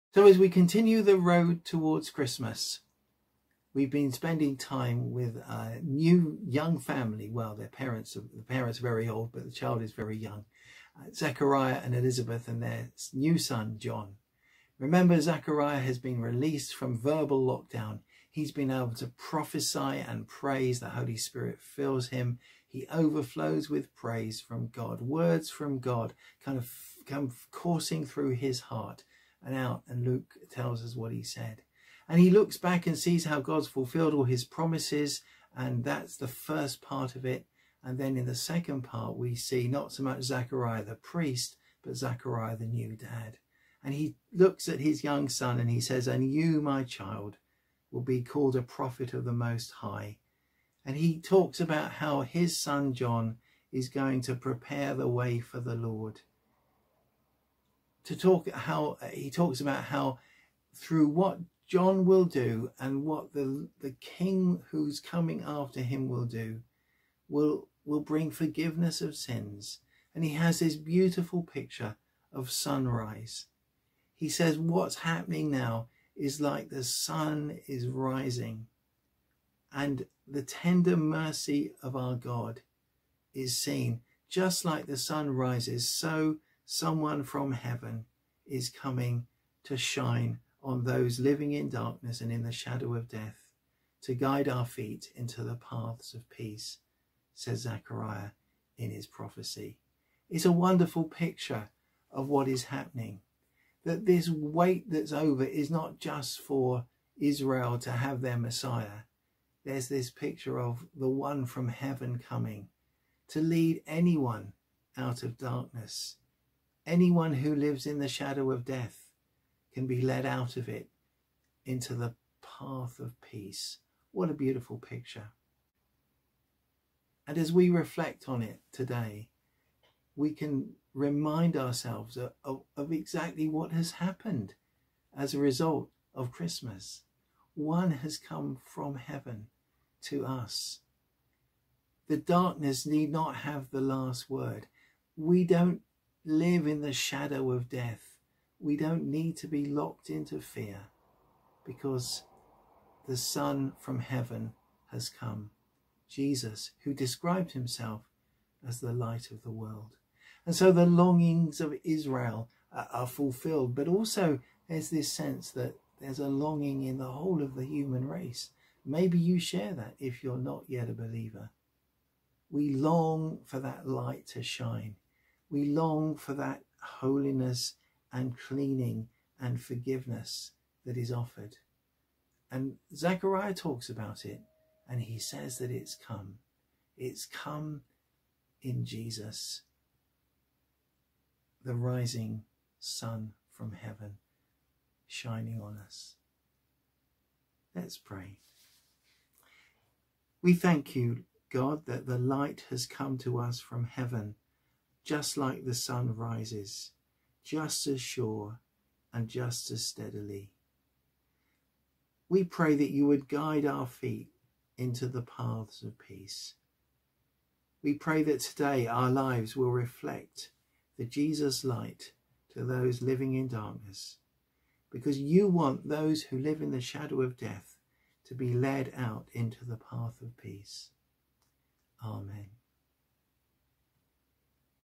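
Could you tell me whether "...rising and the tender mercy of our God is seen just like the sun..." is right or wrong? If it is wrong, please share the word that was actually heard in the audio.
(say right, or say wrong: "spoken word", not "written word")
right.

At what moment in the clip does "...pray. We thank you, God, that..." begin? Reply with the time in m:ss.
3:17.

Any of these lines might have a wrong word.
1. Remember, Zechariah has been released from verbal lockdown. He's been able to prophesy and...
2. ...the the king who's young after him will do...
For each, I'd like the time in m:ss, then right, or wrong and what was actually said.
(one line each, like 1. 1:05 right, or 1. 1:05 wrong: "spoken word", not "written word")
1. 0:14 right
2. 1:03 wrong: "coming", not "young".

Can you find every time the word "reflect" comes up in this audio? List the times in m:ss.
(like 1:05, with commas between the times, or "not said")
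2:07, 3:39.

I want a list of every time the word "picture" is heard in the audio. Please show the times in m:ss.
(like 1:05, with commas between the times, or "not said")
1:11, 1:41, 1:50, 2:04.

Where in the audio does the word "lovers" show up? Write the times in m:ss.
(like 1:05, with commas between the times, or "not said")
not said.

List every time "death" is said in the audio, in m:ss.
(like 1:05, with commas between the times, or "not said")
1:33, 1:58, 2:27, 3:47.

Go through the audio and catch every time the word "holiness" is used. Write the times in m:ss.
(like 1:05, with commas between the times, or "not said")
2:56.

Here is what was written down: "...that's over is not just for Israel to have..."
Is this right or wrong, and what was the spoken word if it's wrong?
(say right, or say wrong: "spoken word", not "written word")
right.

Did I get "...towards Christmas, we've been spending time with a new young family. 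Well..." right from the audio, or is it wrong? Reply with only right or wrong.
right.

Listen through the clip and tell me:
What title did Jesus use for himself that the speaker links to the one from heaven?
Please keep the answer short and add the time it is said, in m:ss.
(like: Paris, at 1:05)
The light of the world, at 2:38.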